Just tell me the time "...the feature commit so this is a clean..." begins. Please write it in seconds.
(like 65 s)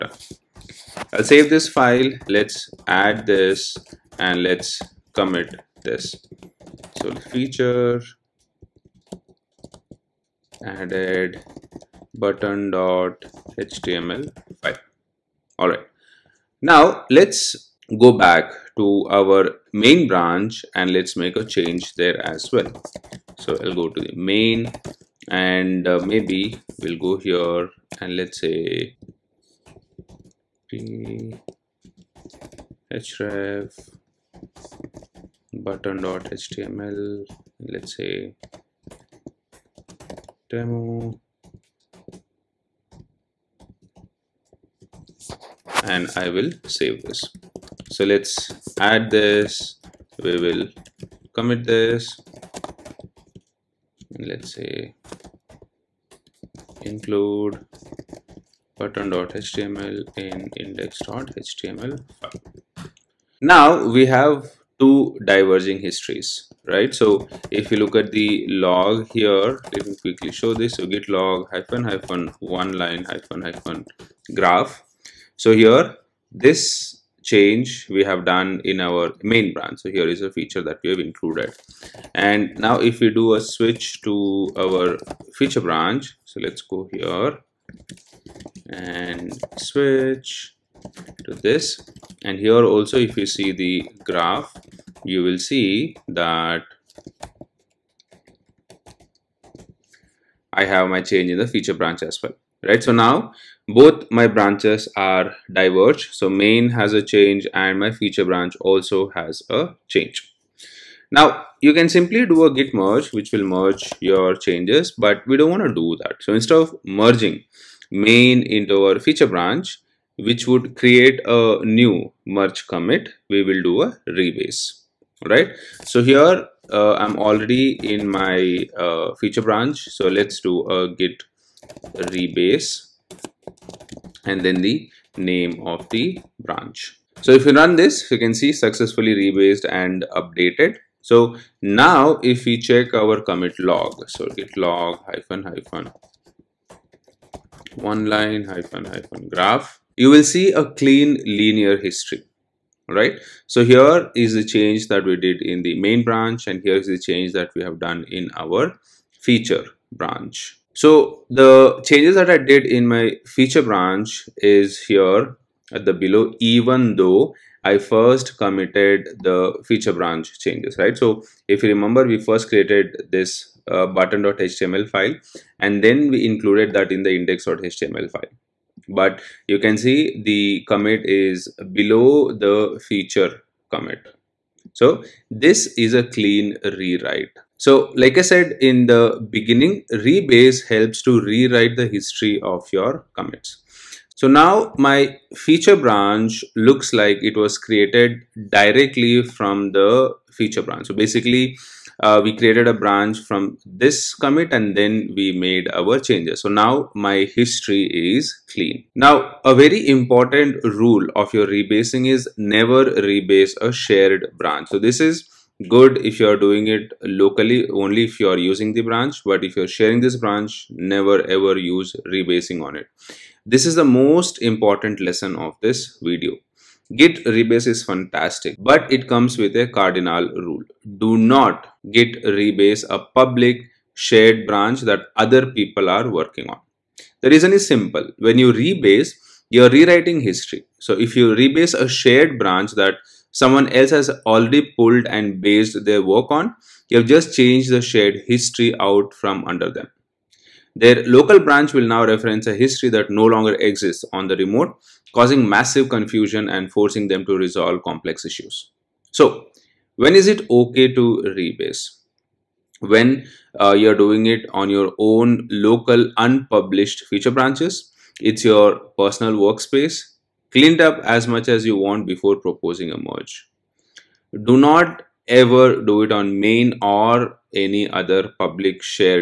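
182 s.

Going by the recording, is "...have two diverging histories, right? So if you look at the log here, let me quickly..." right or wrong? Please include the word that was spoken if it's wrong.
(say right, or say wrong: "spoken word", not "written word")
right.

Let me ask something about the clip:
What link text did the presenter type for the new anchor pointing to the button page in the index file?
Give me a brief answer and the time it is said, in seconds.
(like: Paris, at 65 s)
demo, at 40 s.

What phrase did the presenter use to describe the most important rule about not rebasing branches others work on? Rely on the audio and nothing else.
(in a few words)
cardinal rule.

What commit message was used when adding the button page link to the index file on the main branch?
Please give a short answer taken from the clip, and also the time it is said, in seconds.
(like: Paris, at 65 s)
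include button.html in index.html file, at 56 s.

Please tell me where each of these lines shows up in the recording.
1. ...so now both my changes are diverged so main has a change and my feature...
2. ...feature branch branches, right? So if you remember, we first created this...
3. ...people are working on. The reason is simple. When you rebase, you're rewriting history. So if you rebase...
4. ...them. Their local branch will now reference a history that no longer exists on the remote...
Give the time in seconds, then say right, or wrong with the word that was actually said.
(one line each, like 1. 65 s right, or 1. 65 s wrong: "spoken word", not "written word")
1. 102 s wrong: "branches", not "changes"
2. 169 s wrong: "changes", not "branches"
3. 235 s right
4. 249 s right.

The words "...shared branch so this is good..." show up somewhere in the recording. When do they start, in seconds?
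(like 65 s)
213 s.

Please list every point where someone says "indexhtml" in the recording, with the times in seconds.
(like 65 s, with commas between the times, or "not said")
60 s, 177 s.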